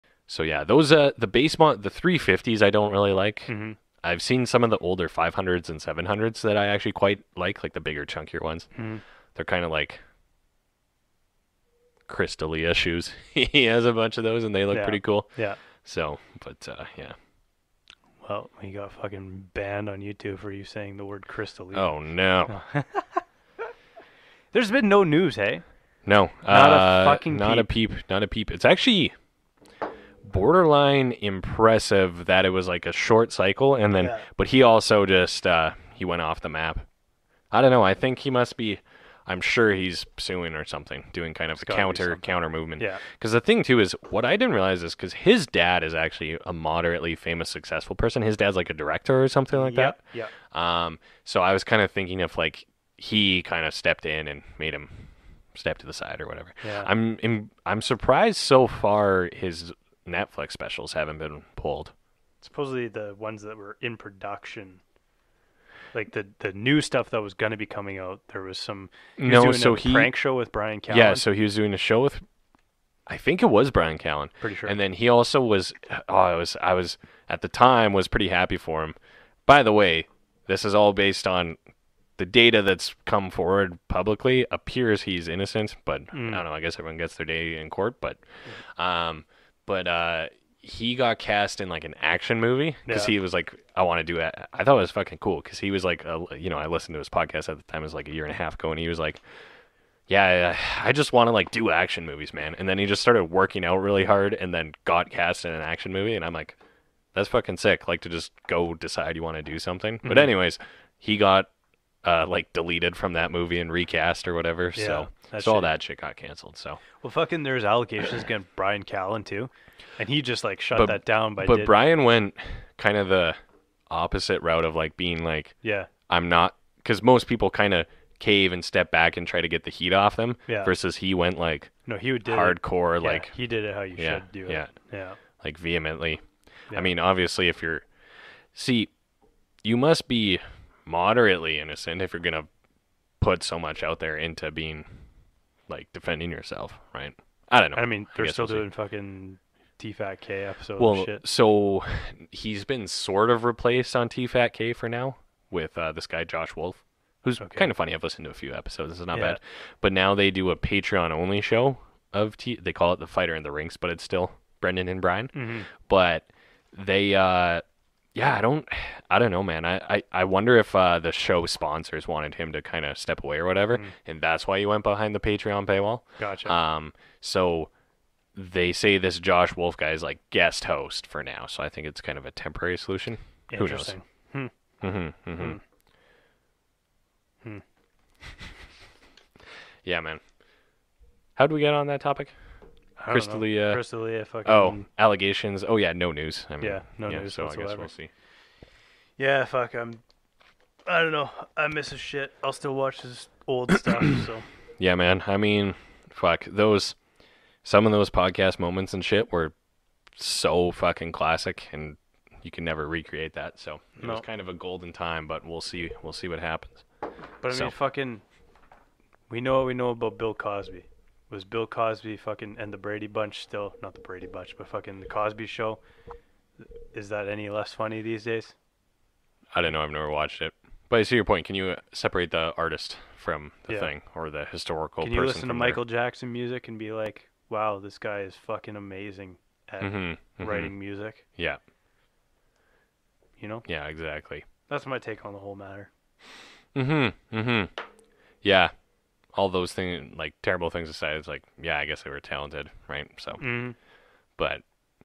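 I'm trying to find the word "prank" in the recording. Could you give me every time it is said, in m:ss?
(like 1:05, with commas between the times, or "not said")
1:09.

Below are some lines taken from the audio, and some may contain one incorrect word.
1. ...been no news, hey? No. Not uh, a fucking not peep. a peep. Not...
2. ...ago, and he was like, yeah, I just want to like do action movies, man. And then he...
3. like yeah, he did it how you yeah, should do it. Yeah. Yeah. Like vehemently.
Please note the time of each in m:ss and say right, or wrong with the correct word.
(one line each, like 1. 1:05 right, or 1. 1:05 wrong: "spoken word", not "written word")
1. 0:24 right
2. 1:38 right
3. 2:13 right.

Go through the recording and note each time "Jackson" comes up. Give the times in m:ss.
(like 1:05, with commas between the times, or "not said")
3:55.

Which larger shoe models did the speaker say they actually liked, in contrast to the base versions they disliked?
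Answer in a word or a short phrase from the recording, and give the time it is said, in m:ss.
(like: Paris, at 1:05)
500s and 700s, at 0:05.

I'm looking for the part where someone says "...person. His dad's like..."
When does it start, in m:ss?
0:47.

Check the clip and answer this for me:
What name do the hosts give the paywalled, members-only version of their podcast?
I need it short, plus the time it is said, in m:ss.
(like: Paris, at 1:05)
The Fighter in the Rinks, at 2:42.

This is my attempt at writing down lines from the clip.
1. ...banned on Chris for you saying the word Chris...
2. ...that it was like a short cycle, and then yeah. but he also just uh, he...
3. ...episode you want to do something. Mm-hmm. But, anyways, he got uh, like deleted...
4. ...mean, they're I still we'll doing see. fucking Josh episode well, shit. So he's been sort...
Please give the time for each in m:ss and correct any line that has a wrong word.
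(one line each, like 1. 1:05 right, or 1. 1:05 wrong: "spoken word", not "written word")
1. 0:19 wrong: "YouTube", not "Chris"
2. 0:32 right
3. 1:48 wrong: "decide", not "episode"
4. 2:27 wrong: "TFATK", not "Josh".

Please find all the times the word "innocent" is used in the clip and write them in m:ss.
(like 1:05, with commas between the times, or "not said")
1:25, 2:21.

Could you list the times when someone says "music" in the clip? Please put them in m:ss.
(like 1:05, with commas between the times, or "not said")
3:56, 4:00.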